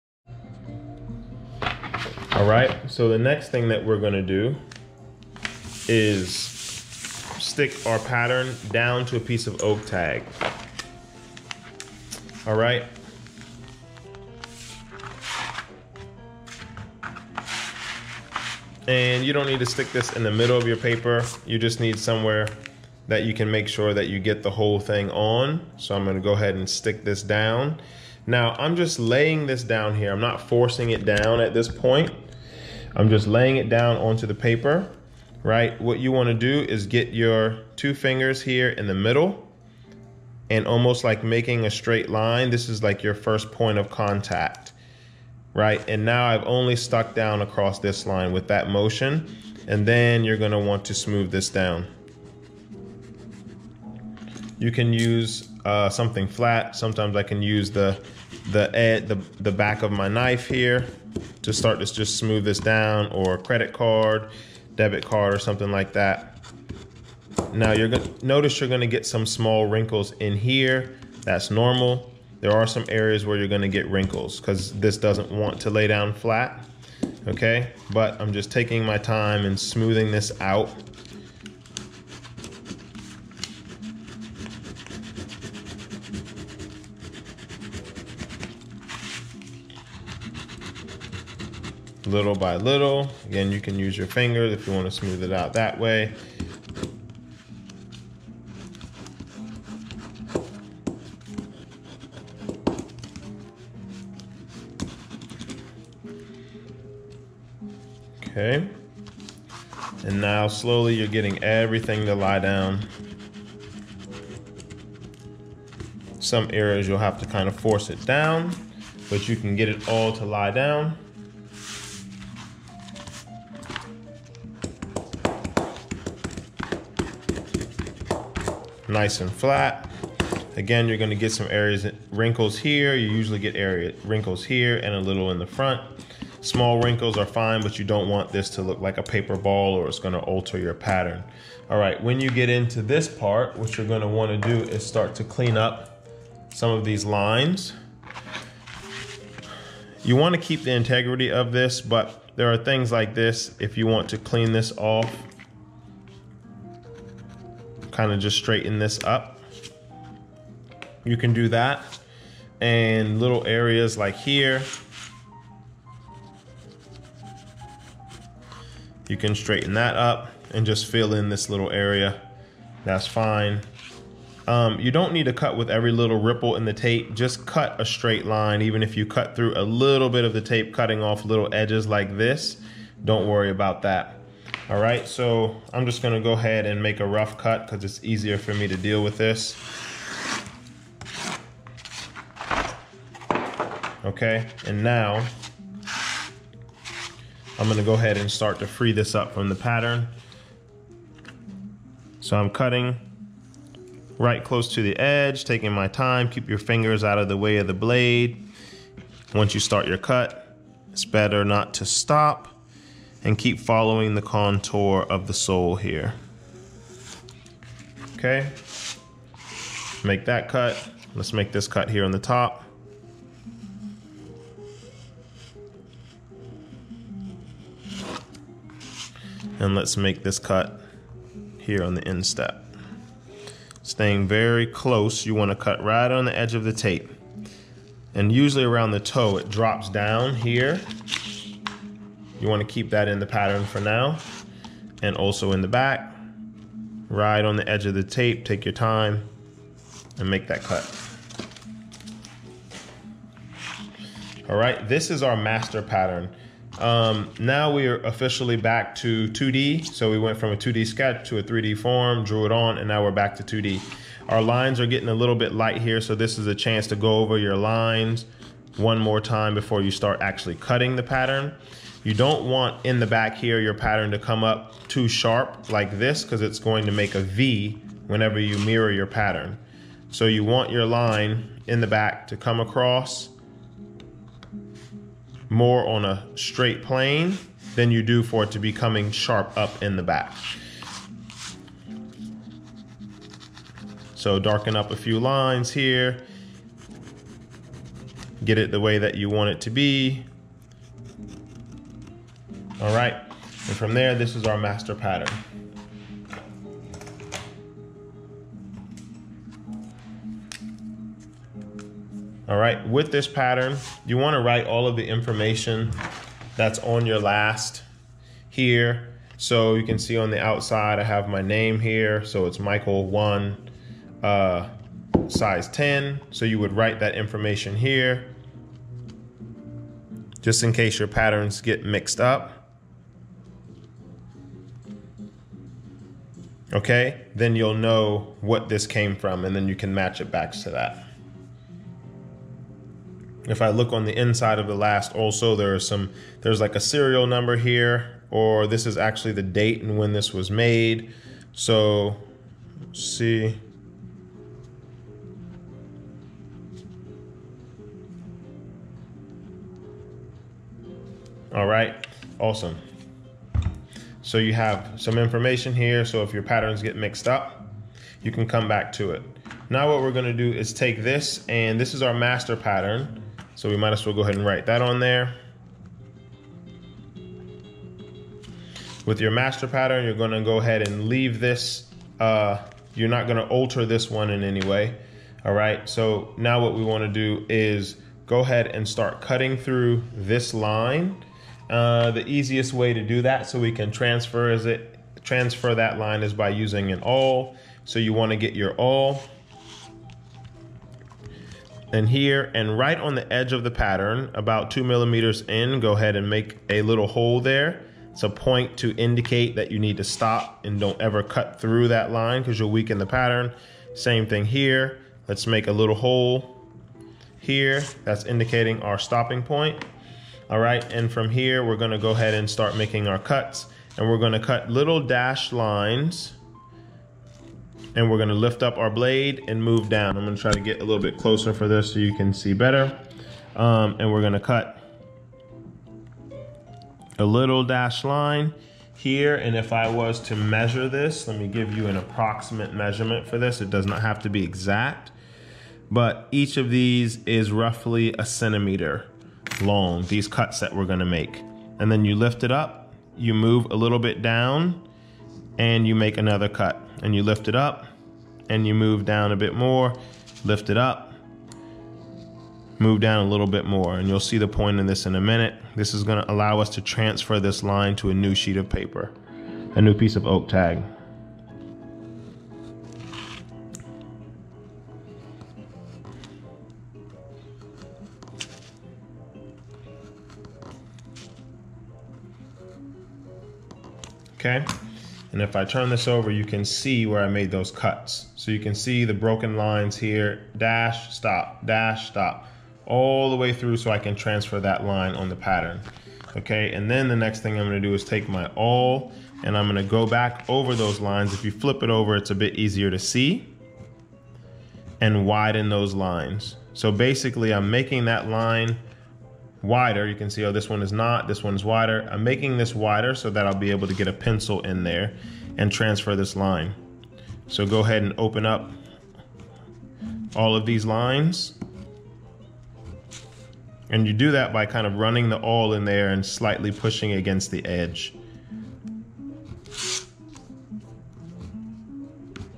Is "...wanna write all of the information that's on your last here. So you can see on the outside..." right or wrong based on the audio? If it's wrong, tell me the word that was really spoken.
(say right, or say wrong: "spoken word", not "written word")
right.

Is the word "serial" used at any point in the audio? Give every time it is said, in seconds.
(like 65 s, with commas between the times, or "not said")
346 s.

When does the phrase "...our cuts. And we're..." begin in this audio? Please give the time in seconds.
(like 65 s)
423 s.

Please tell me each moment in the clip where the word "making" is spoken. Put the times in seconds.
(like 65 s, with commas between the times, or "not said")
41 s, 422 s, 507 s, 512 s.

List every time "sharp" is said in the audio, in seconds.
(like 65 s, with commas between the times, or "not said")
275 s, 289 s.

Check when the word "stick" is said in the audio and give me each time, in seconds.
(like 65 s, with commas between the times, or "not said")
6 s, 19 s, 26 s.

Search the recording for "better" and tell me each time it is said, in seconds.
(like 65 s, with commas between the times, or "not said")
211 s, 432 s.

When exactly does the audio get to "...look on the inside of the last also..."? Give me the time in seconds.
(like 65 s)
343 s.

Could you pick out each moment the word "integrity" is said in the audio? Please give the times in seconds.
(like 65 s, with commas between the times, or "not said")
150 s.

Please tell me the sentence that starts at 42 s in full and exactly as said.
This is like your first point of contact, right?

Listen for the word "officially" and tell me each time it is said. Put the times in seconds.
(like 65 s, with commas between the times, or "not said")
257 s.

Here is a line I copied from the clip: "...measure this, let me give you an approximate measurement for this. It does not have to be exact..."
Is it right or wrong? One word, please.
right.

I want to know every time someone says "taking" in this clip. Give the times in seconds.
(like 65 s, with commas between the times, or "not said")
78 s, 205 s.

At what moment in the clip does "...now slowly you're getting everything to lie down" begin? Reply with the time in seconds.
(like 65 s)
110 s.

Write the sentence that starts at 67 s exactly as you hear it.
Now you're gonna notice you're gonna get some small wrinkles in here.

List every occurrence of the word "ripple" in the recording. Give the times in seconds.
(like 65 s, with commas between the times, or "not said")
176 s.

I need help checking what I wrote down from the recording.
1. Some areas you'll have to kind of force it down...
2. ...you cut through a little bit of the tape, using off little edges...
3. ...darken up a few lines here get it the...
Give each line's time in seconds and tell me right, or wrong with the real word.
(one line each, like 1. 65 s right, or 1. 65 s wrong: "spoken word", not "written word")
1. 116 s right
2. 178 s wrong: "cutting", not "using"
3. 294 s right.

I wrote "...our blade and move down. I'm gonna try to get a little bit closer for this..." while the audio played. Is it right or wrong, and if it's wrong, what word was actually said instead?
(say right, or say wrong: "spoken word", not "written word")
right.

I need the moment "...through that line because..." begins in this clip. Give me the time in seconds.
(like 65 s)
411 s.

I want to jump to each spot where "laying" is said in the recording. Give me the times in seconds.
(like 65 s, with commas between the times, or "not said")
28 s, 33 s.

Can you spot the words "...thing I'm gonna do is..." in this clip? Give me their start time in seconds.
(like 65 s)
497 s.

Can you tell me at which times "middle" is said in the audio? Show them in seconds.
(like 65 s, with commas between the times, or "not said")
20 s, 38 s.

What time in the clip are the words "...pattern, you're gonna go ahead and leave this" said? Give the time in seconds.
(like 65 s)
379 s.